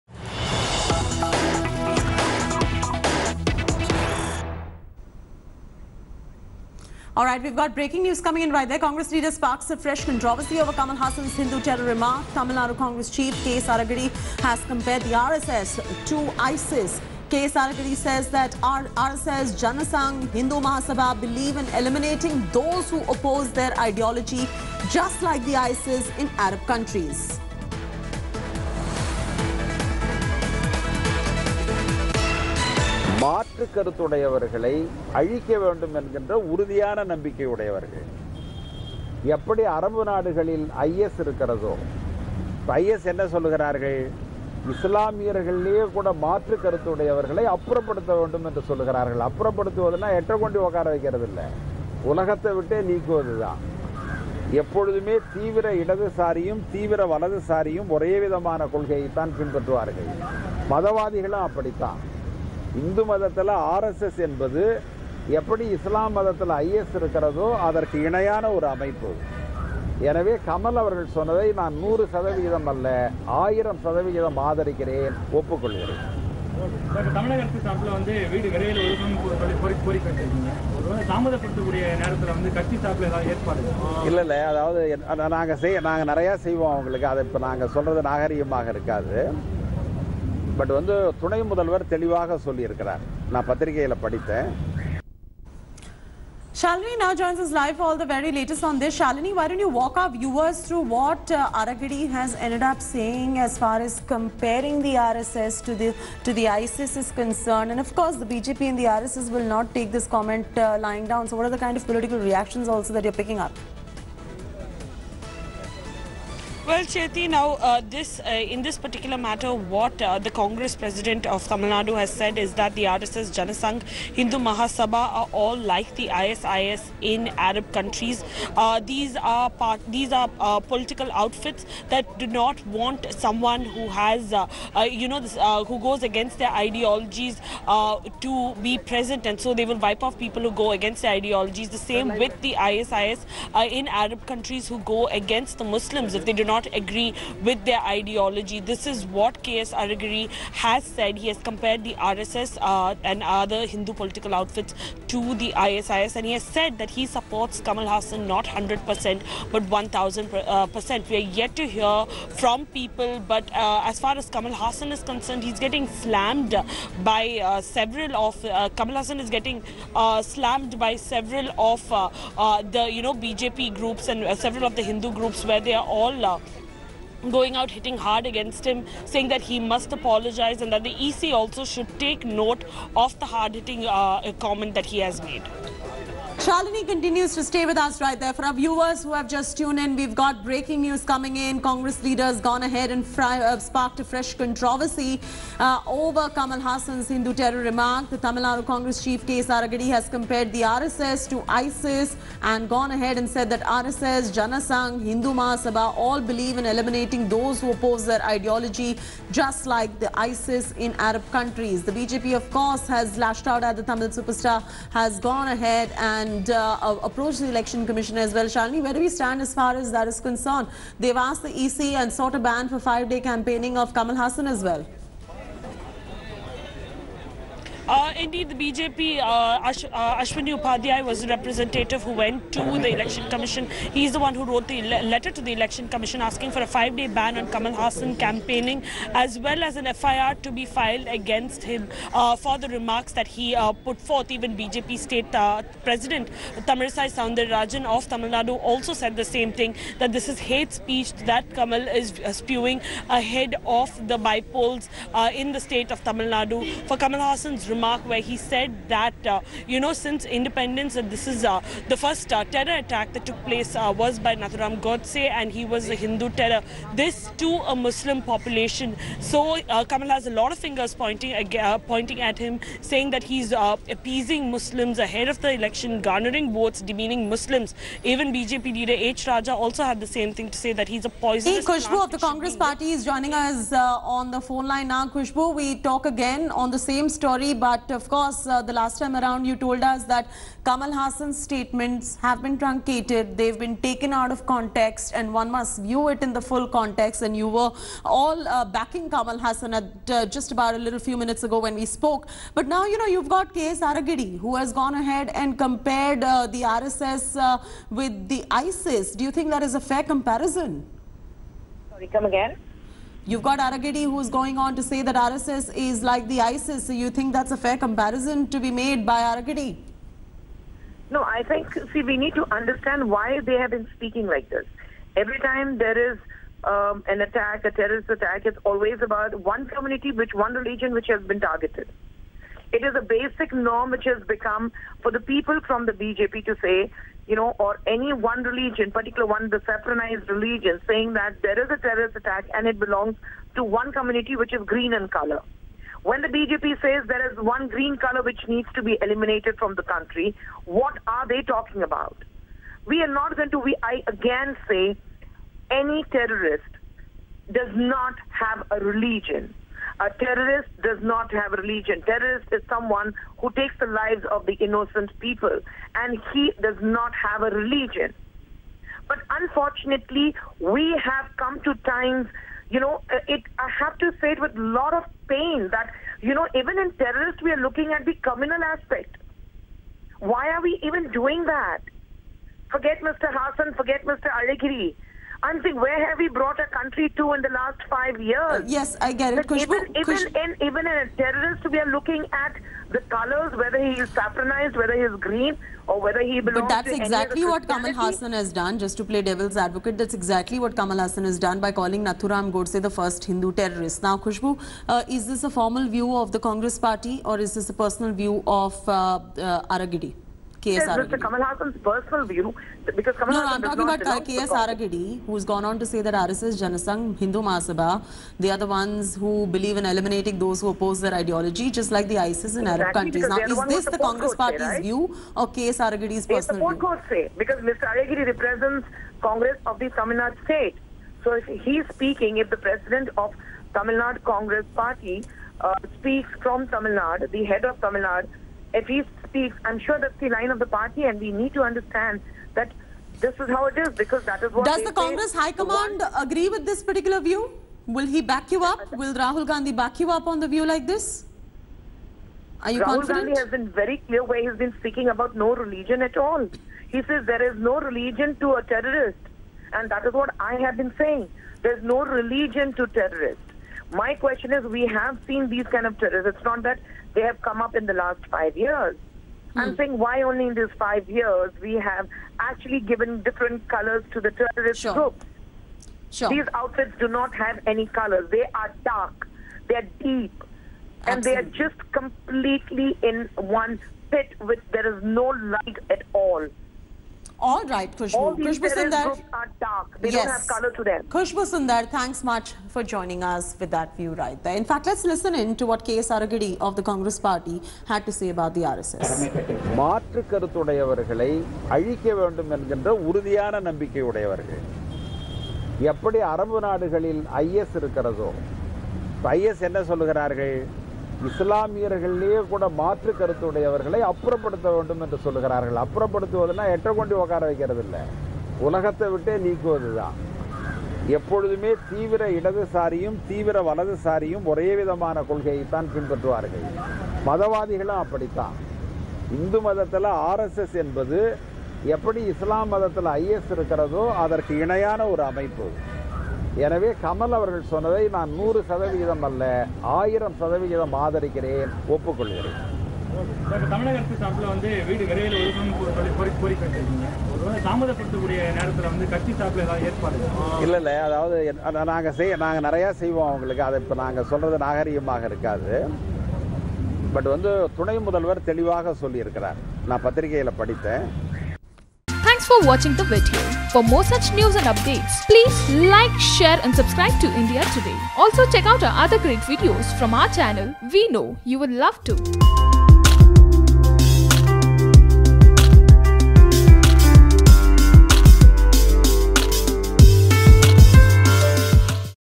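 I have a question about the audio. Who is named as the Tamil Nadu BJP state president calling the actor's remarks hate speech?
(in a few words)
Tamilisai Soundararajan.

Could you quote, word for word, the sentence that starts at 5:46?
When the BJP says there is one green color which needs to be eliminated from the country, what are they talking about?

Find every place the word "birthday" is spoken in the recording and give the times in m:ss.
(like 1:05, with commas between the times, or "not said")
not said.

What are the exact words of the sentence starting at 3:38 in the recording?
Shalini, where do we stand as far as that is concerned?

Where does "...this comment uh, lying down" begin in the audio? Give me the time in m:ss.
1:49.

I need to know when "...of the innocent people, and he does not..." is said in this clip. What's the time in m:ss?
6:04.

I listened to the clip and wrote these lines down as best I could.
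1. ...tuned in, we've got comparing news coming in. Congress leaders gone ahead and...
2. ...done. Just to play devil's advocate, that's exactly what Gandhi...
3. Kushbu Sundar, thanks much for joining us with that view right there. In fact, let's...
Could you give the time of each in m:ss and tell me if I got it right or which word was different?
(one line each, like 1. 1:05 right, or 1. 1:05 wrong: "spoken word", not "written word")
1. 3:09 wrong: "breaking", not "comparing"
2. 6:38 wrong: "Kamal", not "Gandhi"
3. 8:11 right.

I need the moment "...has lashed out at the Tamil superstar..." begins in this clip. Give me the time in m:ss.
3:32.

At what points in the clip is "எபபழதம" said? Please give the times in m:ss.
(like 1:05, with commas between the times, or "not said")
0:54, 8:41.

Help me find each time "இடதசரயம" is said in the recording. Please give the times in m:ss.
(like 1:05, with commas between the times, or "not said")
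0:55, 8:42.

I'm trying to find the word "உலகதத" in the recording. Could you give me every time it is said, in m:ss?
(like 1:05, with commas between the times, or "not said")
0:52, 8:38.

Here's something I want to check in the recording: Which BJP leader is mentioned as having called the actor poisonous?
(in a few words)
H. Raja.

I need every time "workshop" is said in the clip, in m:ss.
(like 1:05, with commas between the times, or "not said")
not said.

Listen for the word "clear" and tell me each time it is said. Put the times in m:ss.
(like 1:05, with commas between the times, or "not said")
7:34.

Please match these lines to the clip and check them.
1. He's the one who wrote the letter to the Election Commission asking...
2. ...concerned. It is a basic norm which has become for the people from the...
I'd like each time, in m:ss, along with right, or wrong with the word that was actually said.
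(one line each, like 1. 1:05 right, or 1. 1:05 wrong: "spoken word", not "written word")
1. 3:53 right
2. 5:31 wrong: "targeted", not "concerned".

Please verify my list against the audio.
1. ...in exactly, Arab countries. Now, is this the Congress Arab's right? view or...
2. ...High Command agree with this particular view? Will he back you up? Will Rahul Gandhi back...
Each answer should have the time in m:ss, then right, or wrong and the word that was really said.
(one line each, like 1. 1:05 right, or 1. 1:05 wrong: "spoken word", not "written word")
1. 7:02 wrong: "Party", not "Arab"
2. 7:25 right.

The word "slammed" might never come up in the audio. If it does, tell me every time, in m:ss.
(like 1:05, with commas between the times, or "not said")
2:45, 2:50.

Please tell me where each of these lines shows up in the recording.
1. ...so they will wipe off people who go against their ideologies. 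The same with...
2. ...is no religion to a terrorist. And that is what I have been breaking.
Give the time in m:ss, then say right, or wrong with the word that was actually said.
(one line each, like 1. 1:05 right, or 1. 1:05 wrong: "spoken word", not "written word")
1. 2:19 right
2. 7:37 wrong: "saying", not "breaking".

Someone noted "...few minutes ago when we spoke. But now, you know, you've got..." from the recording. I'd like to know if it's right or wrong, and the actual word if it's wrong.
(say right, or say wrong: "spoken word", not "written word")
right.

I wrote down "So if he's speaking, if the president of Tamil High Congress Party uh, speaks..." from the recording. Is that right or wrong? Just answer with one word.
wrong.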